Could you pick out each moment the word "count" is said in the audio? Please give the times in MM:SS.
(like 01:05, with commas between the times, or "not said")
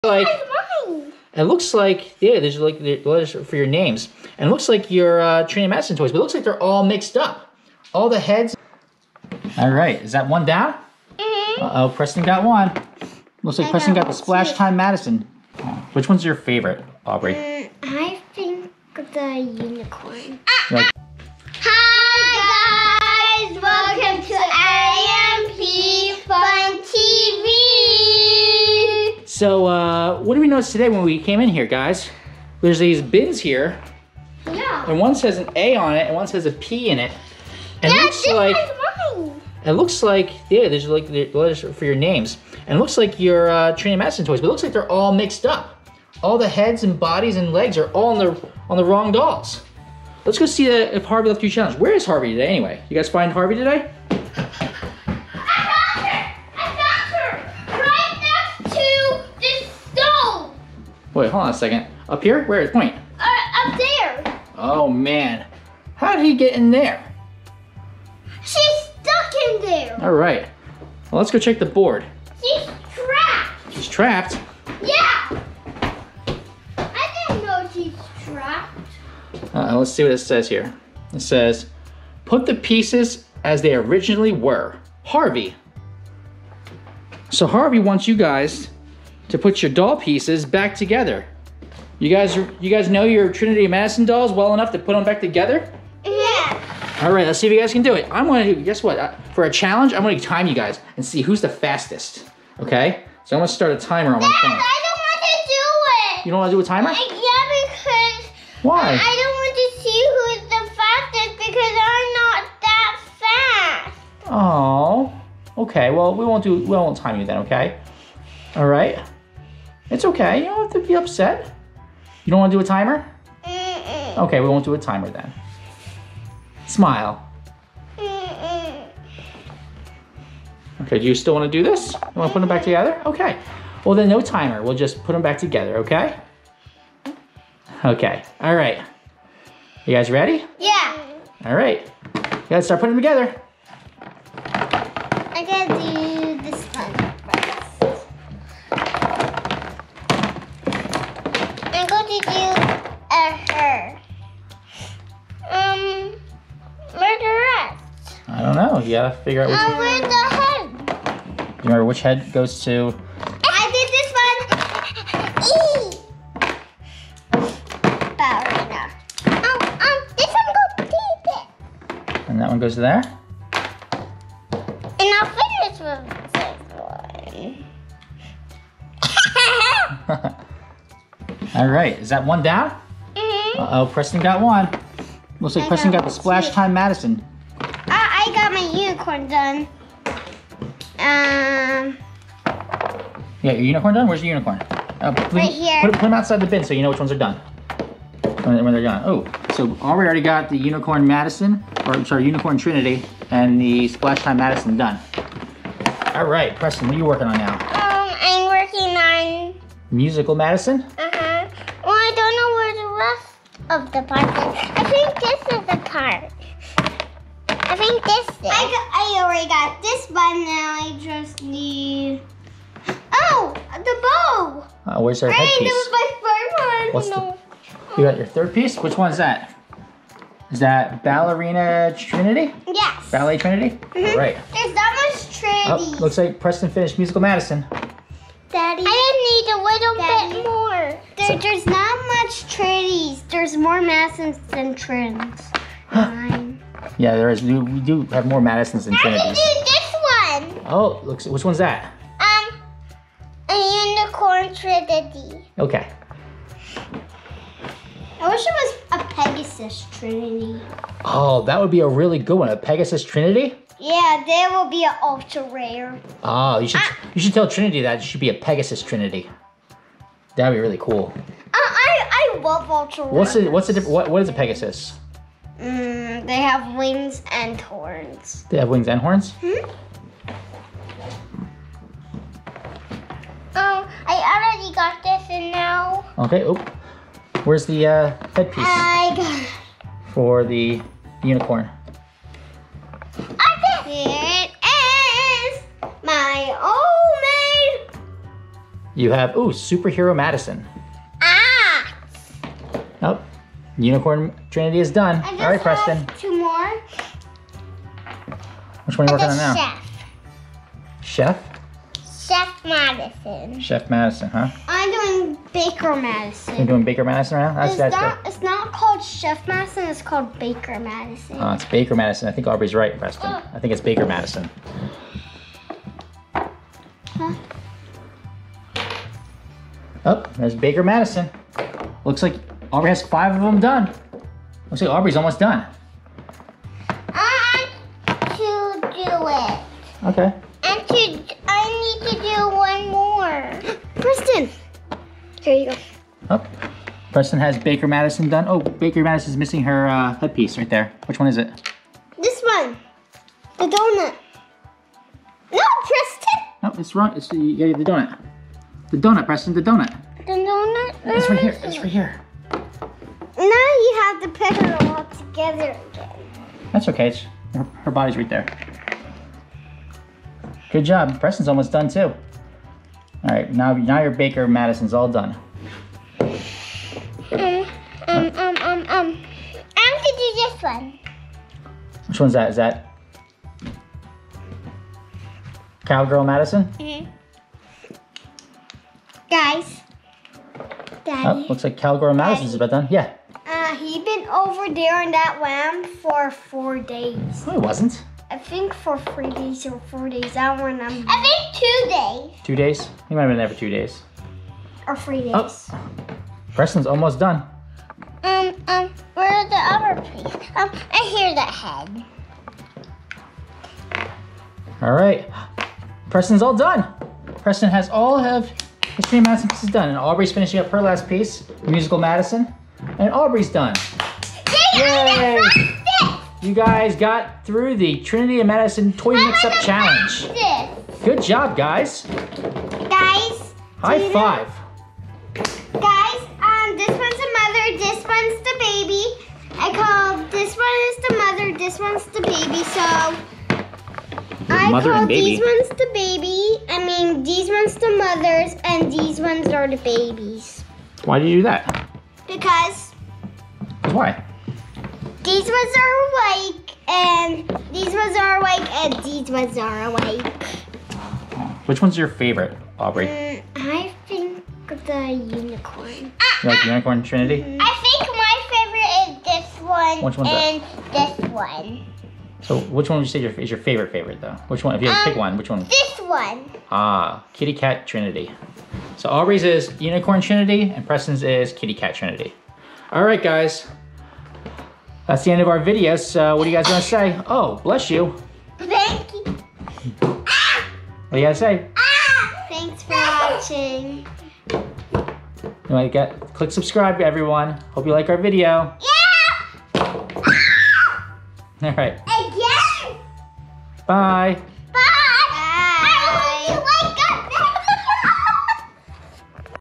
not said.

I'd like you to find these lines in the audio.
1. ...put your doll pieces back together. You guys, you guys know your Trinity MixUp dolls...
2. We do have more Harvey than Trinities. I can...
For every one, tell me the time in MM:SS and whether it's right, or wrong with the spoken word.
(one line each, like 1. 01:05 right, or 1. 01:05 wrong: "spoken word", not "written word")
1. 01:29 wrong: "Madison", not "MixUp"
2. 04:07 wrong: "Madisons", not "Harvey".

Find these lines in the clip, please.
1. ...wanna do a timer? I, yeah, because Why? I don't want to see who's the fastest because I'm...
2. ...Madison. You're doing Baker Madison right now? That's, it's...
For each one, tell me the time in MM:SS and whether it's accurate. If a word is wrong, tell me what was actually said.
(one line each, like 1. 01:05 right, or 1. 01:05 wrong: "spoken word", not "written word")
1. 01:46 right
2. 05:15 right.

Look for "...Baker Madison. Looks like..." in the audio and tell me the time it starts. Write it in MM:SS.
05:30.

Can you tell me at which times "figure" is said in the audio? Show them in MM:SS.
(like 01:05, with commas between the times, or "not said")
02:39.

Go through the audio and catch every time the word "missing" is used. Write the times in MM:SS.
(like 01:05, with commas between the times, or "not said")
05:49.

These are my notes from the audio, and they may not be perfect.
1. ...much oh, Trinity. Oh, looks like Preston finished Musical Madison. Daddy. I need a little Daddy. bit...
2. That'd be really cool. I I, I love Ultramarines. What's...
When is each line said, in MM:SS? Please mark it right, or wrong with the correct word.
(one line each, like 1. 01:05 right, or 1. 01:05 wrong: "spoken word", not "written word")
1. 03:55 right
2. 04:30 right.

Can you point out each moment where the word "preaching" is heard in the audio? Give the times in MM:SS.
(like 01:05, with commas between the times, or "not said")
not said.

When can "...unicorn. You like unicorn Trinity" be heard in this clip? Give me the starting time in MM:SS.
07:45.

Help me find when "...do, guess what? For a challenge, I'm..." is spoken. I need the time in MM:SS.
01:38.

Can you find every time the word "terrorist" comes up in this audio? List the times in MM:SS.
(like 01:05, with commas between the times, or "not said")
not said.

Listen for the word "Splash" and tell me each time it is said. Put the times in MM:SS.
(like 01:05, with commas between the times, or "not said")
00:14, 03:06, 03:23.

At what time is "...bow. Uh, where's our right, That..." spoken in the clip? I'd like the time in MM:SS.
03:44.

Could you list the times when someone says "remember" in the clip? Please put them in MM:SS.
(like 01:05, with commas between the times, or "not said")
02:41, 06:40.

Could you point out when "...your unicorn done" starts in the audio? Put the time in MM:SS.
03:13.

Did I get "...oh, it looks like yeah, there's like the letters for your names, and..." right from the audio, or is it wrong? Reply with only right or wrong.
right.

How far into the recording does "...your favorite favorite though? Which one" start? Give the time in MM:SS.
07:53.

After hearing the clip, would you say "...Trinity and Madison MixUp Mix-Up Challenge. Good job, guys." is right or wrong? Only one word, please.
wrong.